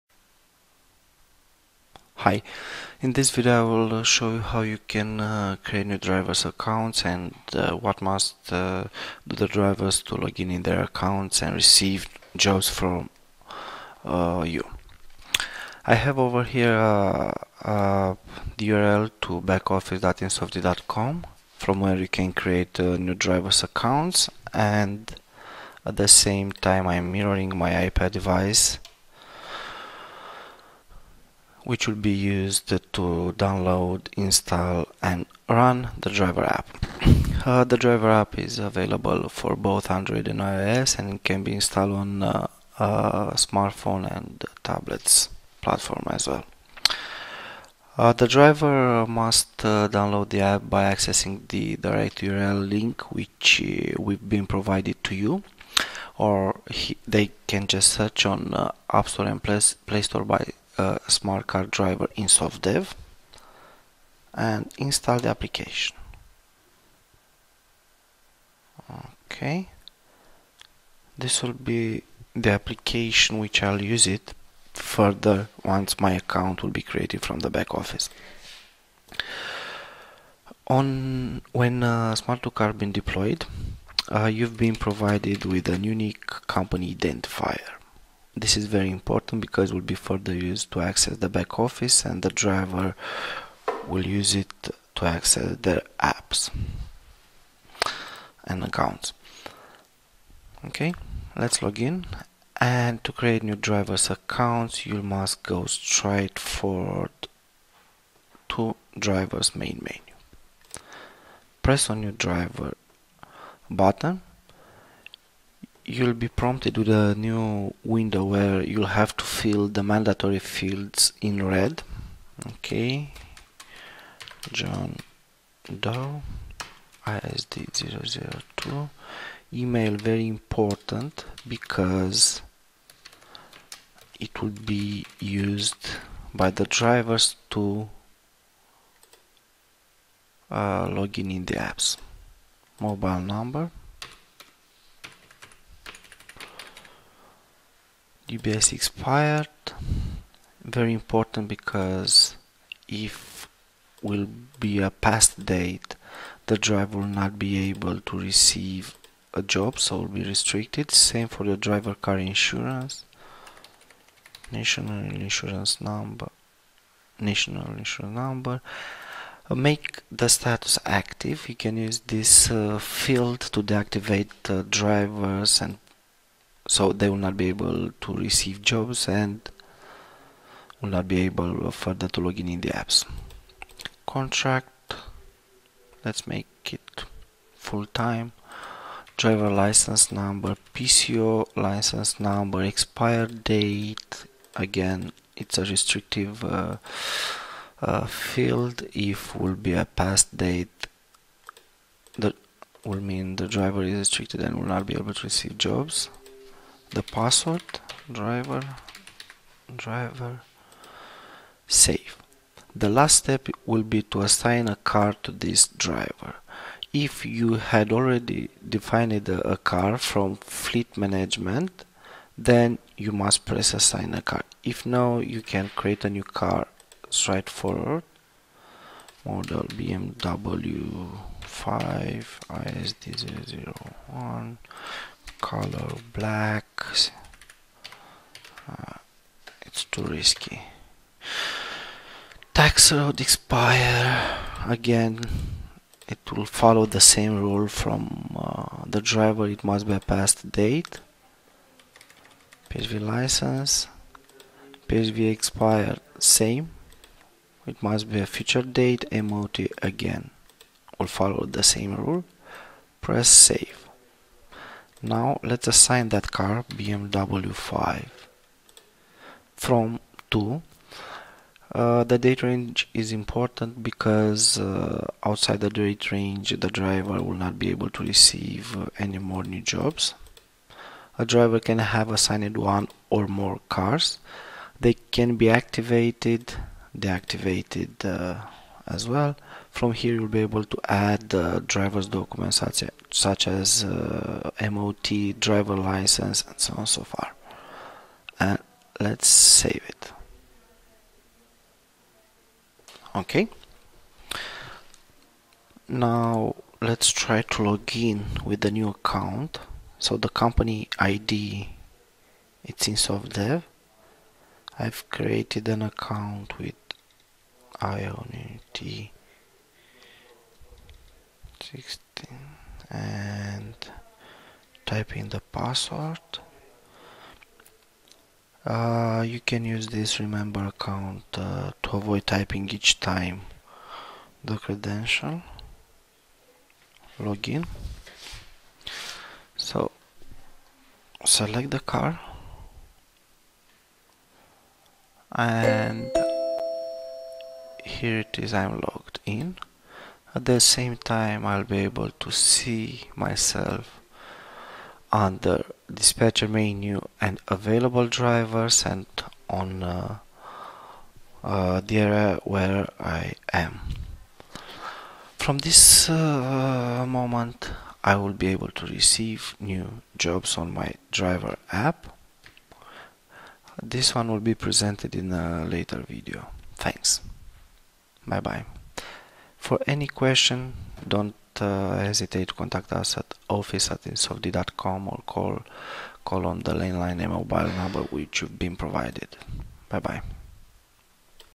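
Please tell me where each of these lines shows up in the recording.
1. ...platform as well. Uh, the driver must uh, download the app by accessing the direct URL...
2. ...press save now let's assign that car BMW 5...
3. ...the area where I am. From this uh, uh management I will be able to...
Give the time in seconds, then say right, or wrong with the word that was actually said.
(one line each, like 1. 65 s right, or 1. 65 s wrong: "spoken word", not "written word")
1. 45 s right
2. 263 s right
3. 361 s wrong: "moment", not "management".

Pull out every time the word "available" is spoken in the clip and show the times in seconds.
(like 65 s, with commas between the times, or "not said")
38 s, 357 s.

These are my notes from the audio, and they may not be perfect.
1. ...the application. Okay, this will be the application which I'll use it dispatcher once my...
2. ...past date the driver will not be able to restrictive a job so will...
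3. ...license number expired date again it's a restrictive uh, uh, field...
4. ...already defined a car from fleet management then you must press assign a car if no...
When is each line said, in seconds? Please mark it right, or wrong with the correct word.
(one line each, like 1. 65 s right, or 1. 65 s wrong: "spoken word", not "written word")
1. 65 s wrong: "further", not "dispatcher"
2. 154 s wrong: "receive", not "restrictive"
3. 191 s right
4. 217 s right.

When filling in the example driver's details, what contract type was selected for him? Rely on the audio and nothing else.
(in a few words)
full-time.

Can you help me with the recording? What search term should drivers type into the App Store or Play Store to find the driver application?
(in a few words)
Smart2Car driver INSOFTDEV.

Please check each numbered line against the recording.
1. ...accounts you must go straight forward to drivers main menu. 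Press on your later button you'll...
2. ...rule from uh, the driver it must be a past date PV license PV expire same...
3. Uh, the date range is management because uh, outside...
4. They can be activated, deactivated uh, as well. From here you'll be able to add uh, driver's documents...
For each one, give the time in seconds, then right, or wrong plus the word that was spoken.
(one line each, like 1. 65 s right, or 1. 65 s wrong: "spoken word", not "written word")
1. 104 s wrong: "driver", not "later"
2. 247 s right
3. 271 s wrong: "important", not "management"
4. 284 s right.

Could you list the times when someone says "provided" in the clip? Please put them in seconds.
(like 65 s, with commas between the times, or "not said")
54 s, 84 s, 388 s.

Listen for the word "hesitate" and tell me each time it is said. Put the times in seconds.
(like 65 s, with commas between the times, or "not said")
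382 s.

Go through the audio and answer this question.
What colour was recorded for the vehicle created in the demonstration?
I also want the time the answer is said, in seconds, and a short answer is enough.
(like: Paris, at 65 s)
black, at 236 s.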